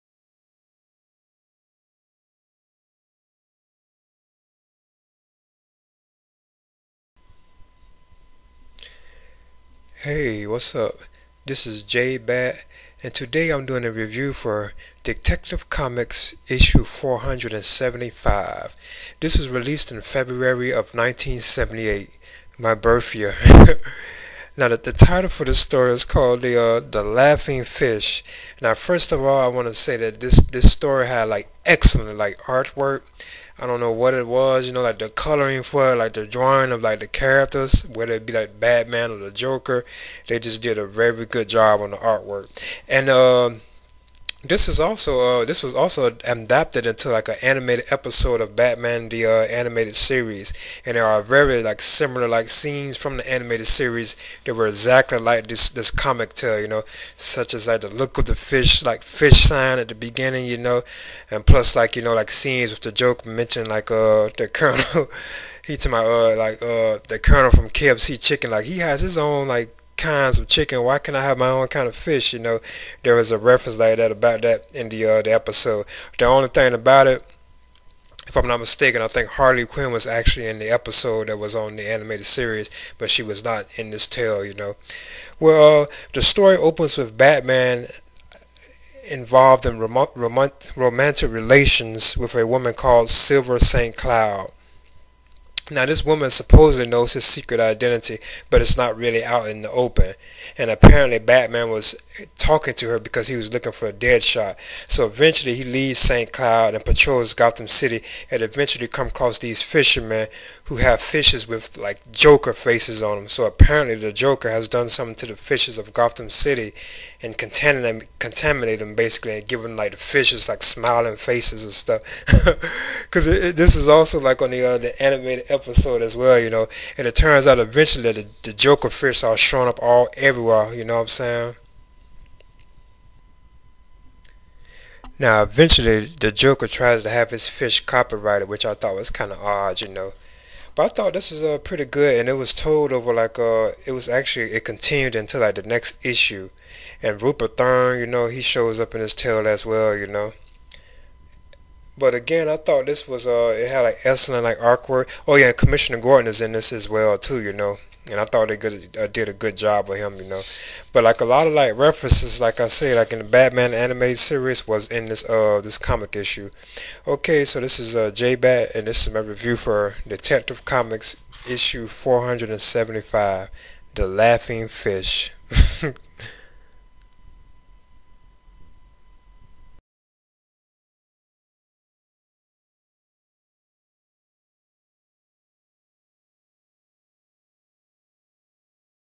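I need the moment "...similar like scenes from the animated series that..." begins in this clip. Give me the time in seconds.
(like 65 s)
51 s.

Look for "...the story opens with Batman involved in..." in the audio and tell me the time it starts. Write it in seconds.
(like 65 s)
86 s.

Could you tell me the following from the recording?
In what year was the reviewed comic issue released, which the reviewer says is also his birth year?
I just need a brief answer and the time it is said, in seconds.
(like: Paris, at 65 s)
1978, at 20 s.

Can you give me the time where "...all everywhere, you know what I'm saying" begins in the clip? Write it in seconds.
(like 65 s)
129 s.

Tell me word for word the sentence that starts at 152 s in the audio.
But again, I thought this was uh, it had like excellent like awkward.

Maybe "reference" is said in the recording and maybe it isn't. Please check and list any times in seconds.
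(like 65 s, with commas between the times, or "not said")
73 s, 161 s.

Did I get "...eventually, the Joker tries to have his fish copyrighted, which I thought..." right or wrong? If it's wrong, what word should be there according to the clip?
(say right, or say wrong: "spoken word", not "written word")
right.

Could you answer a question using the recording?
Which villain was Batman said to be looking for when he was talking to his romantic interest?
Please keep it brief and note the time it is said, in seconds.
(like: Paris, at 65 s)
Deadshot, at 103 s.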